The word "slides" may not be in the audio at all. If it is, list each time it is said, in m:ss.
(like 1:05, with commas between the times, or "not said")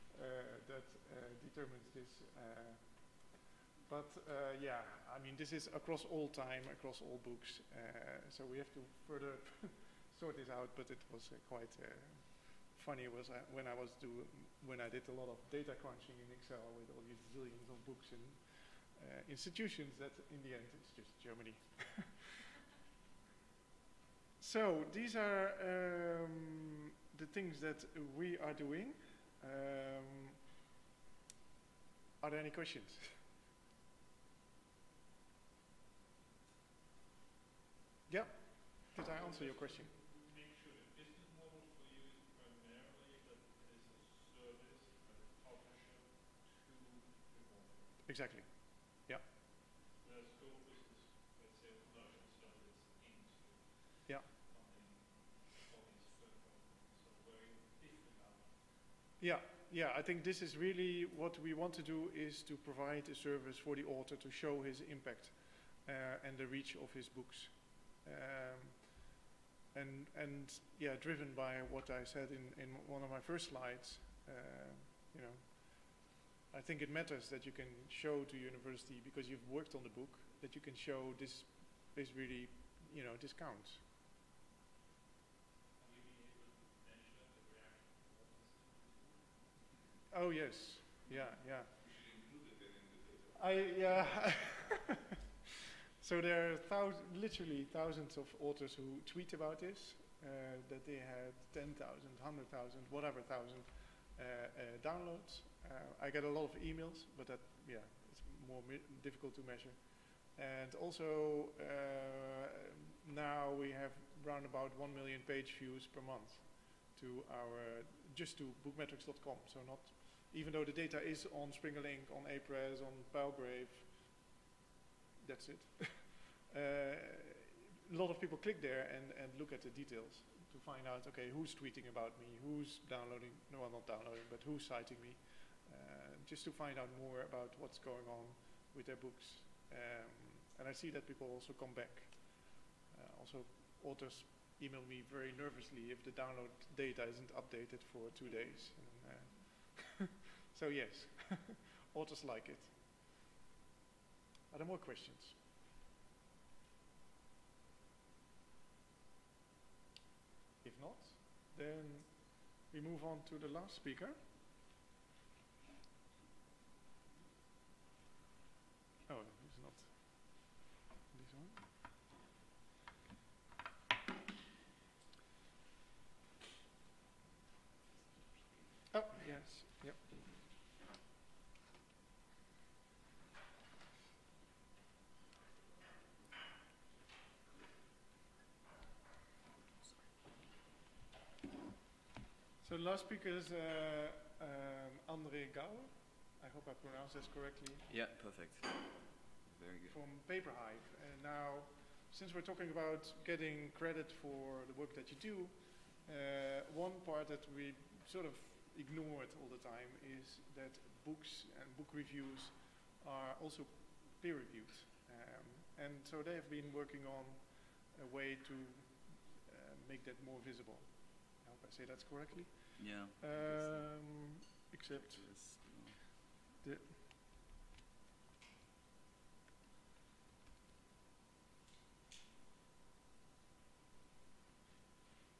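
1:13.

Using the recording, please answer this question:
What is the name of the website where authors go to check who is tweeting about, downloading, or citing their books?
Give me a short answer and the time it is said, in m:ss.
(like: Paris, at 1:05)
bookmetrix.com, at 1:58.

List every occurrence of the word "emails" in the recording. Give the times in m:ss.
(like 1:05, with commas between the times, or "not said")
1:46, 2:24.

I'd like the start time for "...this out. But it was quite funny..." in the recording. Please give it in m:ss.
0:10.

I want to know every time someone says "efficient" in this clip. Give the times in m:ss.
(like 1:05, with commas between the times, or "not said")
not said.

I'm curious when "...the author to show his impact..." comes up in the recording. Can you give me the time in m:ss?
1:03.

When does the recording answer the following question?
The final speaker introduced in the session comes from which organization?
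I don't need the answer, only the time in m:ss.
3:20.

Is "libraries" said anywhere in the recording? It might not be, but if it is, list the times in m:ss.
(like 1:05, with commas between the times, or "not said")
not said.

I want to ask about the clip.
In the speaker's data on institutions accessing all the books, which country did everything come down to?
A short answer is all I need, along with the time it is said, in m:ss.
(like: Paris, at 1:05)
Germany, at 0:21.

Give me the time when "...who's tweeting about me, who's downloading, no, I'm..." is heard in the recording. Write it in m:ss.
2:11.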